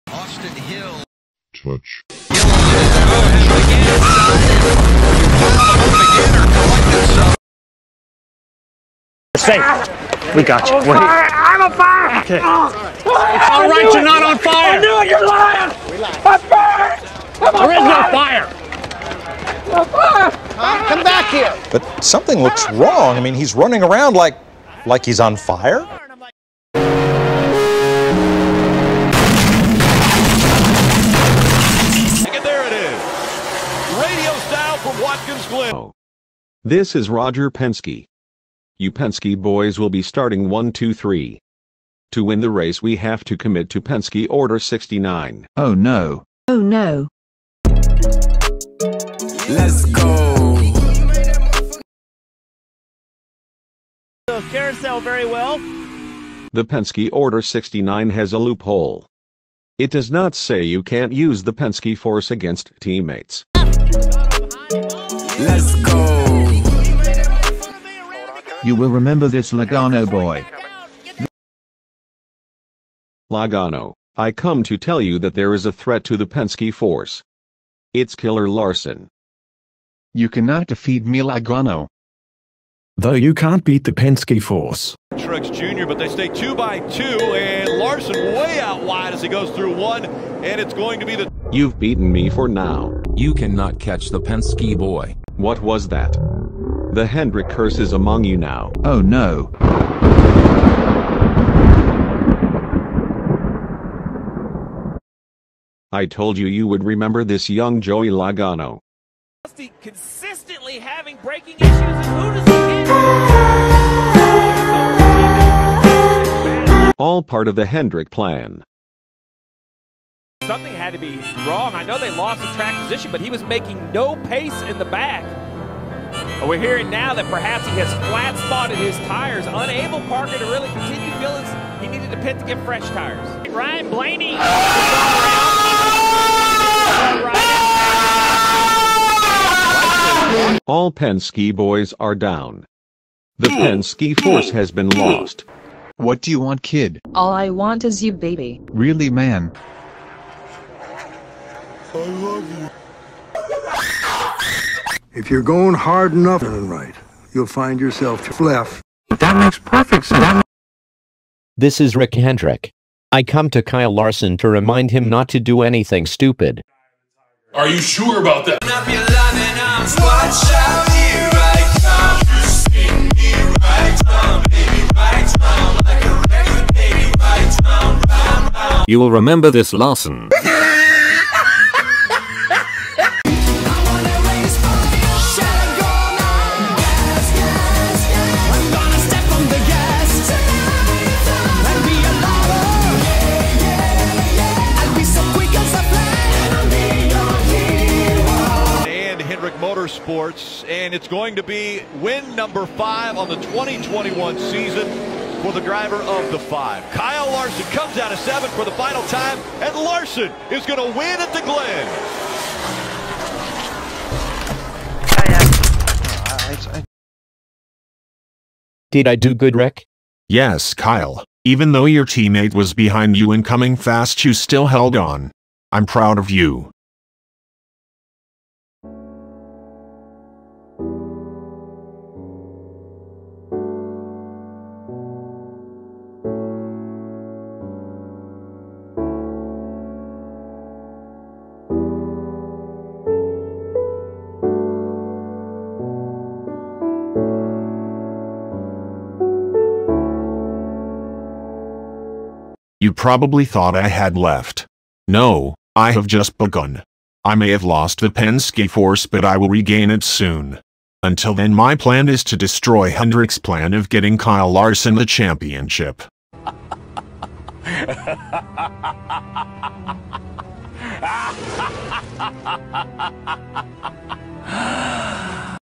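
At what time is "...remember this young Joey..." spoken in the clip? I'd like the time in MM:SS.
01:46.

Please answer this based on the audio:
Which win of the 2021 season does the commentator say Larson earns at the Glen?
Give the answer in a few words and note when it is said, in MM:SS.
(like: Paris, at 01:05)
5, at 03:21.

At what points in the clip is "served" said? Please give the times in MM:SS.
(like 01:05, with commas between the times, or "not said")
not said.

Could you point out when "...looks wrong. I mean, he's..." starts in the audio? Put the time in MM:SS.
00:22.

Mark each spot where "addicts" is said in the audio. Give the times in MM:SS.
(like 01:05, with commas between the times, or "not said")
not said.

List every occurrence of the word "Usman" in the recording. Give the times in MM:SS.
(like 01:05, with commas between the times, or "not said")
not said.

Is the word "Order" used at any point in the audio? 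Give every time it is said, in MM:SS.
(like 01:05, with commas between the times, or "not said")
00:44, 00:57.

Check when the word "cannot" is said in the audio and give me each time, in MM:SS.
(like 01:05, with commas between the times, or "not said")
01:20, 01:33.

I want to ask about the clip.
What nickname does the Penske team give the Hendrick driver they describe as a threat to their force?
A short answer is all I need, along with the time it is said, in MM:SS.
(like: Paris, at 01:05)
Killer Larson, at 01:18.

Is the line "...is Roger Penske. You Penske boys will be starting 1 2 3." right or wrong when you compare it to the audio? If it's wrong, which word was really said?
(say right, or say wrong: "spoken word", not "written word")
right.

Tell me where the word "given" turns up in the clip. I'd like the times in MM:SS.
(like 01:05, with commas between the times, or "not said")
not said.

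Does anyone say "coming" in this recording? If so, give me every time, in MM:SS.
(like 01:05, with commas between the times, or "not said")
03:43.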